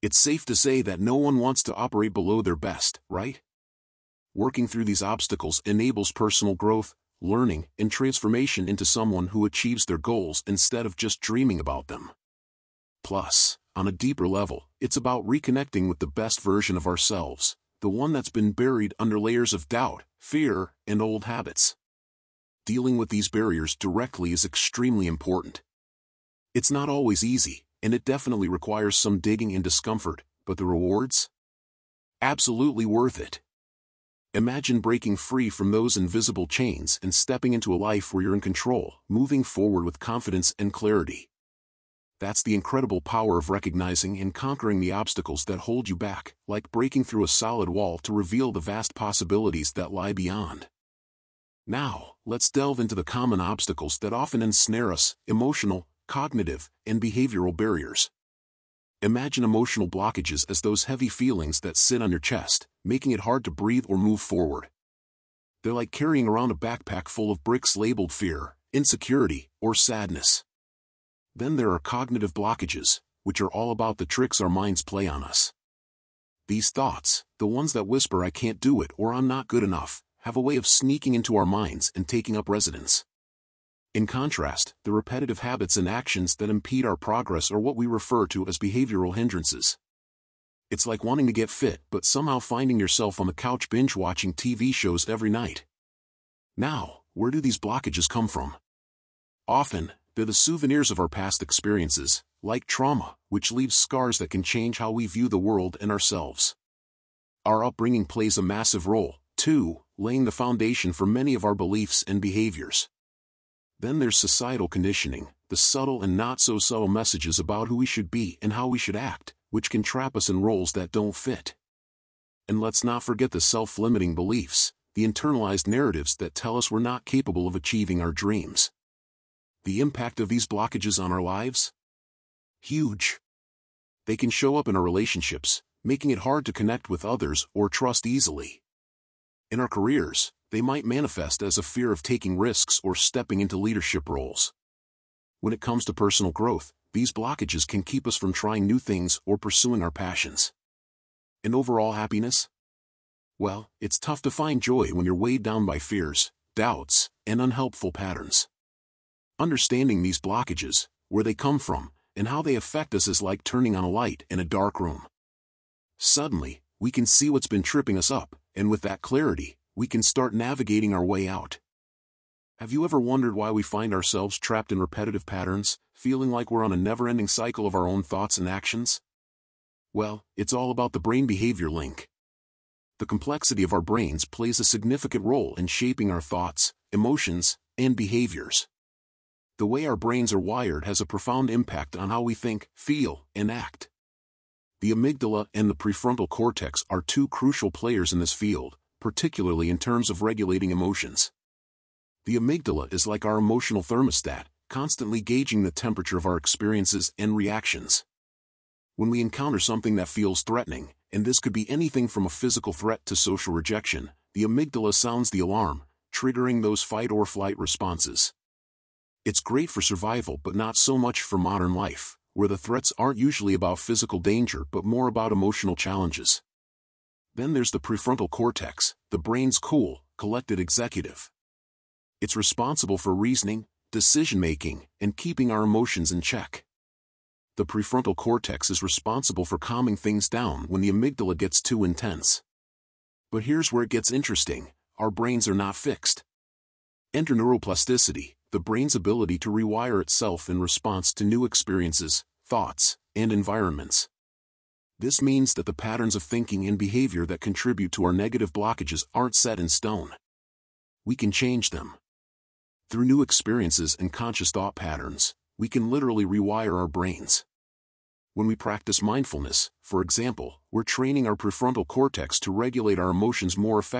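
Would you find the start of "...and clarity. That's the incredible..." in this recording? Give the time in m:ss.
0:40.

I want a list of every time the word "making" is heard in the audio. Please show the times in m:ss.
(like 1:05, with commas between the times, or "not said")
1:02, 2:15, 3:53.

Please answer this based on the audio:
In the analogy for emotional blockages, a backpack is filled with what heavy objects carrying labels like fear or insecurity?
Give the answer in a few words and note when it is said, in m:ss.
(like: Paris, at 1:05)
Bricks, at 1:07.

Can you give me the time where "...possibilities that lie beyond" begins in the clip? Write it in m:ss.
0:48.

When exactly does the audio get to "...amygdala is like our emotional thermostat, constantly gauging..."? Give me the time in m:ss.
3:22.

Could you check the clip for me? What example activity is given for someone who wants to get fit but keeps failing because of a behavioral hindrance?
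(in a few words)
Binge watching TV shows.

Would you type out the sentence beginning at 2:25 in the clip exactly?
When it comes to personal growth, these blockages can keep us from trying new things or pursuing our passions.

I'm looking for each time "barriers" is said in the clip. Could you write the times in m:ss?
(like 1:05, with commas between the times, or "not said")
0:23, 0:57.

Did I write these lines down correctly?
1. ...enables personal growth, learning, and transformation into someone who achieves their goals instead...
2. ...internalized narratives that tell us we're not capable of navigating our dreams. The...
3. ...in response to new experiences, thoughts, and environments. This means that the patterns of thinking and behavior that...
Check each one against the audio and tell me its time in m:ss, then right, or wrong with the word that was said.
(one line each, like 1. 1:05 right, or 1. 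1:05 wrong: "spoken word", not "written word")
1. 0:05 right
2. 2:05 wrong: "achieving", not "navigating"
3. 4:10 right.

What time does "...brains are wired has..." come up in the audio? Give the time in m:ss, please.
3:09.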